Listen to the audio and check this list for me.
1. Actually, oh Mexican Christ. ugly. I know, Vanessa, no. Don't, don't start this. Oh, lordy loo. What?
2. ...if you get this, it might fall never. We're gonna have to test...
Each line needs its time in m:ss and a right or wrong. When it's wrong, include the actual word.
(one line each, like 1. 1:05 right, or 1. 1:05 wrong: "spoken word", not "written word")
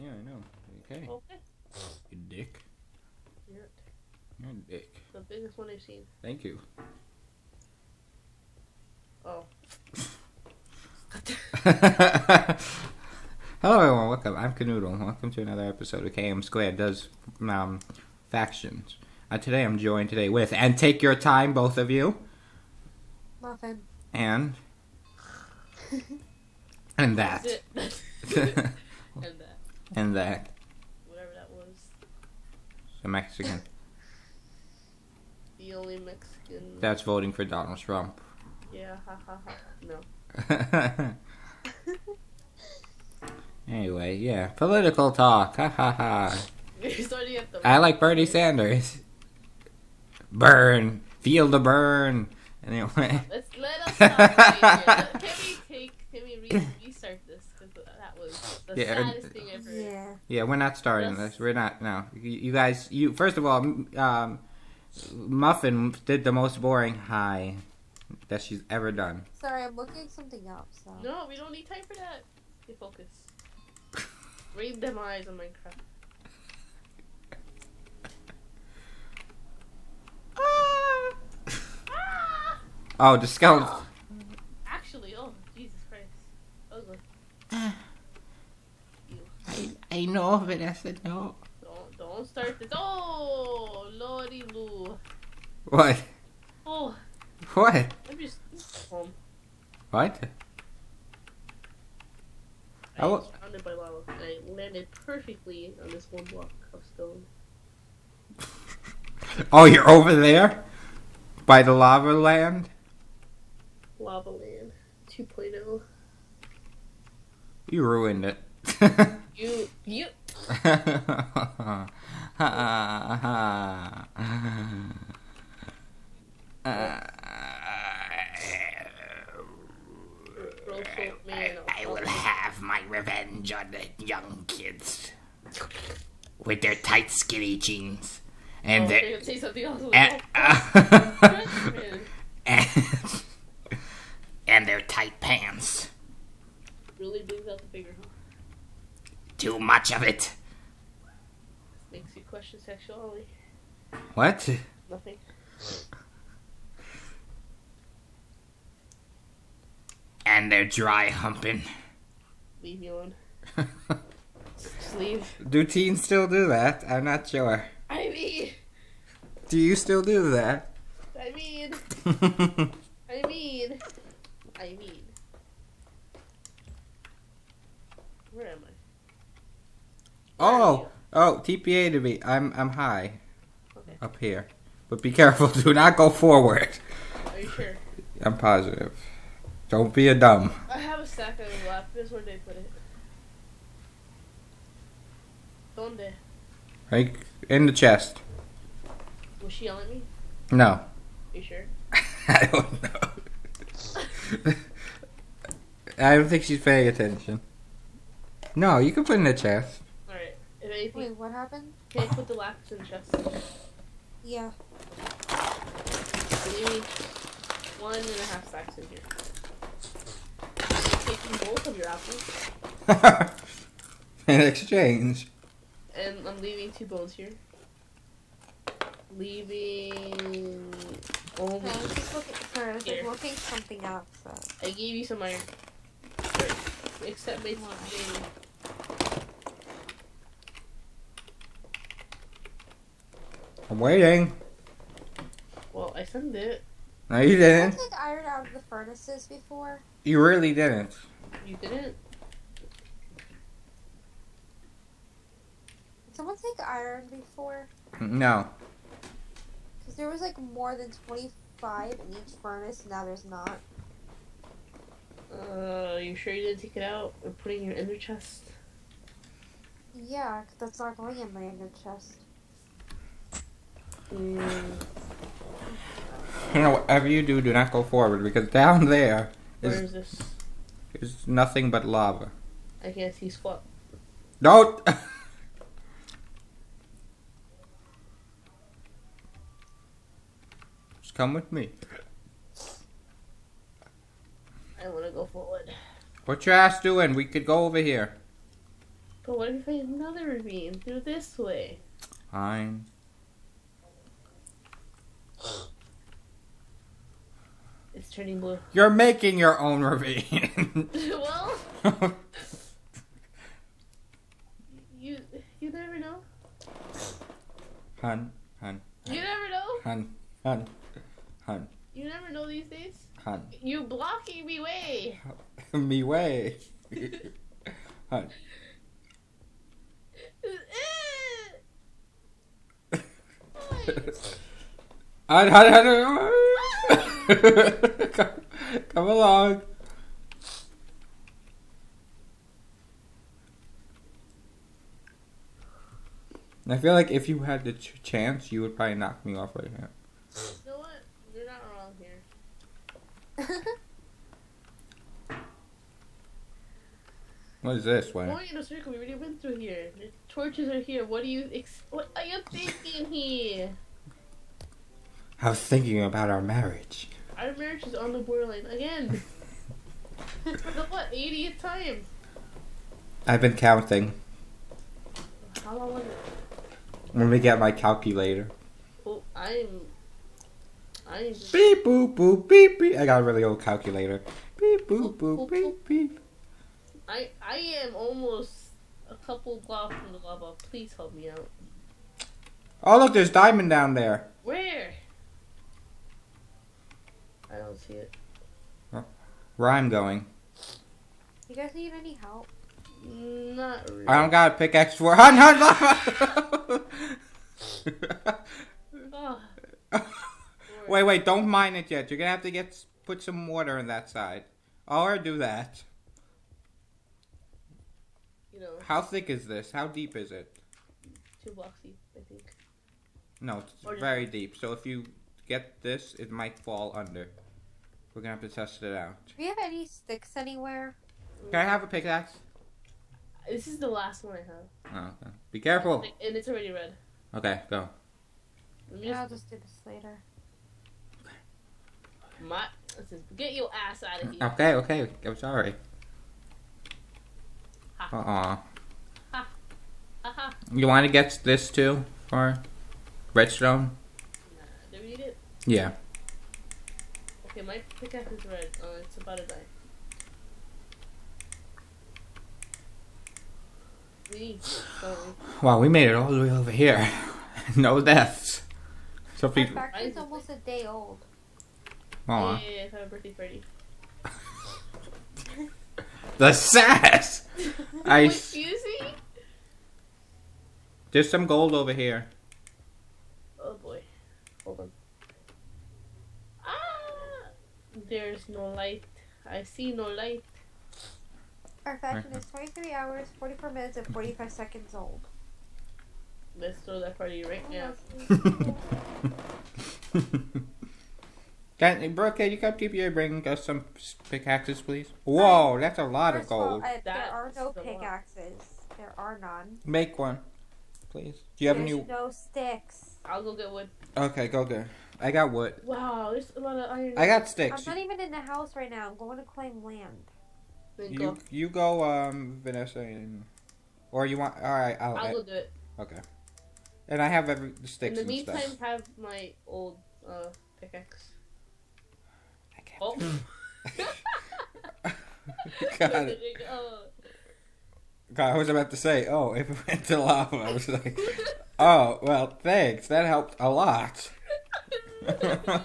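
1. 1:24 wrong: "Jesus", not "Mexican"
2. 7:04 wrong: "under", not "never".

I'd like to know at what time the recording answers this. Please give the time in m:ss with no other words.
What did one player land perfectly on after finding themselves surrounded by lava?
1:46.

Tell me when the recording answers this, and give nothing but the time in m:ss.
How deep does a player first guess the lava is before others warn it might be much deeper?
7:01.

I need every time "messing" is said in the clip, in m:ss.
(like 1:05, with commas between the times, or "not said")
not said.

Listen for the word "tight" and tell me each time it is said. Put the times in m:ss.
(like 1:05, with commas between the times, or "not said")
2:16, 2:24.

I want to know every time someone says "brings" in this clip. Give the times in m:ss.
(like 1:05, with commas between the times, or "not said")
2:27, 8:23.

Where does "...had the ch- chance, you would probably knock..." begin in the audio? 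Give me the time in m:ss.
5:47.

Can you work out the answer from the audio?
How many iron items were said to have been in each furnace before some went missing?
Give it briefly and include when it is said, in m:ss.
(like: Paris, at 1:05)
more than 25, at 4:20.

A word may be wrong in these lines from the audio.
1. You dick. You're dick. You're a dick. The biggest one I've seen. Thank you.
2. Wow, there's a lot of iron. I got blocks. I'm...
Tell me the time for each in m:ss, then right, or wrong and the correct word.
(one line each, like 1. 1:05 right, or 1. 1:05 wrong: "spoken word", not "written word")
1. 0:02 right
2. 8:35 wrong: "sticks", not "blocks".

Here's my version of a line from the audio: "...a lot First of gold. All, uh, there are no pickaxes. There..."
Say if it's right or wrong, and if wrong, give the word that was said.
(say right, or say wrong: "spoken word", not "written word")
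right.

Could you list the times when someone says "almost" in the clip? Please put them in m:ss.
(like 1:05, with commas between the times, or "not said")
6:27, 7:50.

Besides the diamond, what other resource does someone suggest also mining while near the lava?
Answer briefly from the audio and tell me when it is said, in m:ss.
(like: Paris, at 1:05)
redstone, at 7:33.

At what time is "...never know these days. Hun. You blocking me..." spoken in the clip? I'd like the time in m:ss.
5:22.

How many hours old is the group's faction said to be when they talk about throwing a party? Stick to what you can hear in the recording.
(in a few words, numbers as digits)
23 hours.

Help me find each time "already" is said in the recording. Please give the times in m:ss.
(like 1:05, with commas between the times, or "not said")
5:58, 7:16.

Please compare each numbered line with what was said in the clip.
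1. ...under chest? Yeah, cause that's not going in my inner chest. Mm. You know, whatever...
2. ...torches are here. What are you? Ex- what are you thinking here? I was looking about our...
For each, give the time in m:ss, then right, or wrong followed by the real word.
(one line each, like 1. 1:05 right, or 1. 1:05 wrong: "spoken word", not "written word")
1. 4:27 wrong: "inner", not "under"
2. 6:00 wrong: "thinking", not "looking".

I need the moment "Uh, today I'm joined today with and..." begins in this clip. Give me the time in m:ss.
0:19.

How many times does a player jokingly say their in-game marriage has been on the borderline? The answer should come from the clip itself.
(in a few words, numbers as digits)
80th.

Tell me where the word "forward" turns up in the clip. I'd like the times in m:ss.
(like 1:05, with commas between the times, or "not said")
3:06, 4:37, 4:55.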